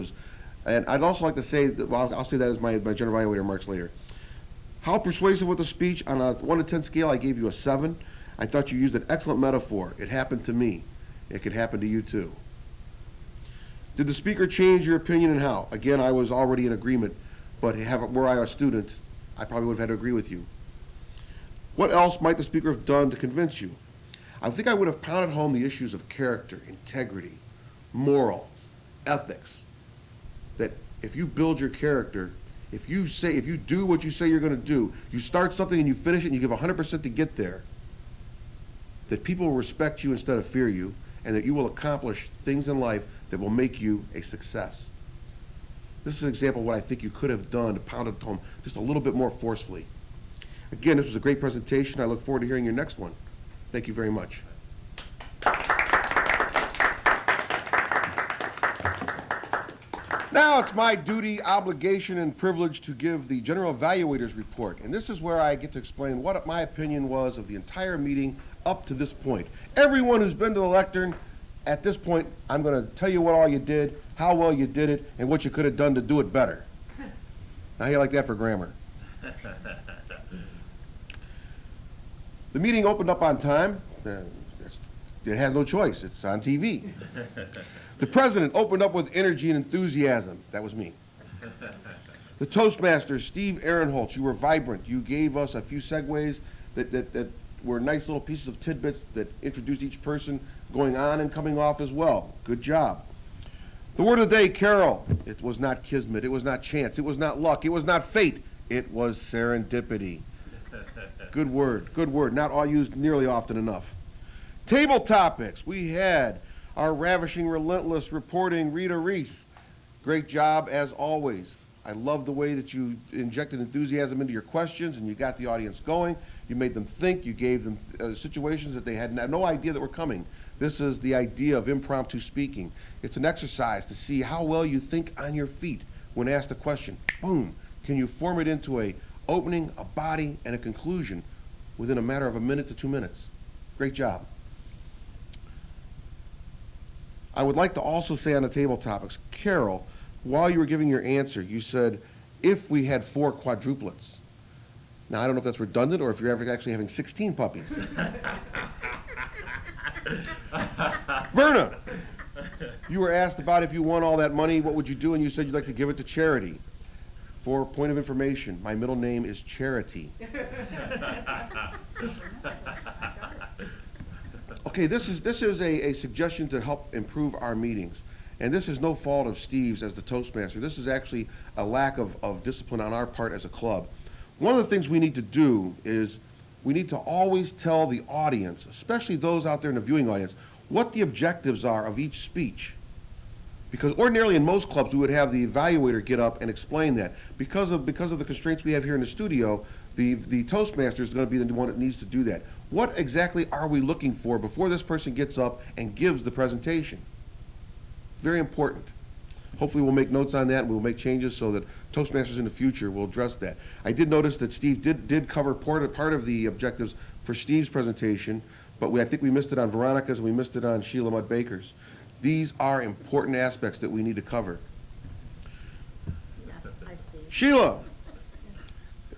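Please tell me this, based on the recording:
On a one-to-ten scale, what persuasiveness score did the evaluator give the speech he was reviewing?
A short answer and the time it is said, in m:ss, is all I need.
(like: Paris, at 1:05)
7, at 0:07.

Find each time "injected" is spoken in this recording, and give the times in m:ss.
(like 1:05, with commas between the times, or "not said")
2:03.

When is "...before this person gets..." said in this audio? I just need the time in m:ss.
3:24.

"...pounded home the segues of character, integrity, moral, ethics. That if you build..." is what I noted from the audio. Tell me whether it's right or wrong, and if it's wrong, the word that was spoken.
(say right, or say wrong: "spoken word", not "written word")
wrong: "issues", not "segues".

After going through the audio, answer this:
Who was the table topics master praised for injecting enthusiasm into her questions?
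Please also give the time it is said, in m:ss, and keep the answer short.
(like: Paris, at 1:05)
Rita Reece, at 1:58.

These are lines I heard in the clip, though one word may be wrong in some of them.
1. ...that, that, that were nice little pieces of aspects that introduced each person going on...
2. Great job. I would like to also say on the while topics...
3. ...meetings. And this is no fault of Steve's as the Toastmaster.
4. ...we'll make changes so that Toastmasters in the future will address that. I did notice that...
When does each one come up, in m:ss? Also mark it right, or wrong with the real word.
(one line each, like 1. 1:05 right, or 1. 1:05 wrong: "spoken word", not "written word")
1. 1:36 wrong: "tidbits", not "aspects"
2. 2:23 wrong: "table", not "while"
3. 2:57 right
4. 3:30 right.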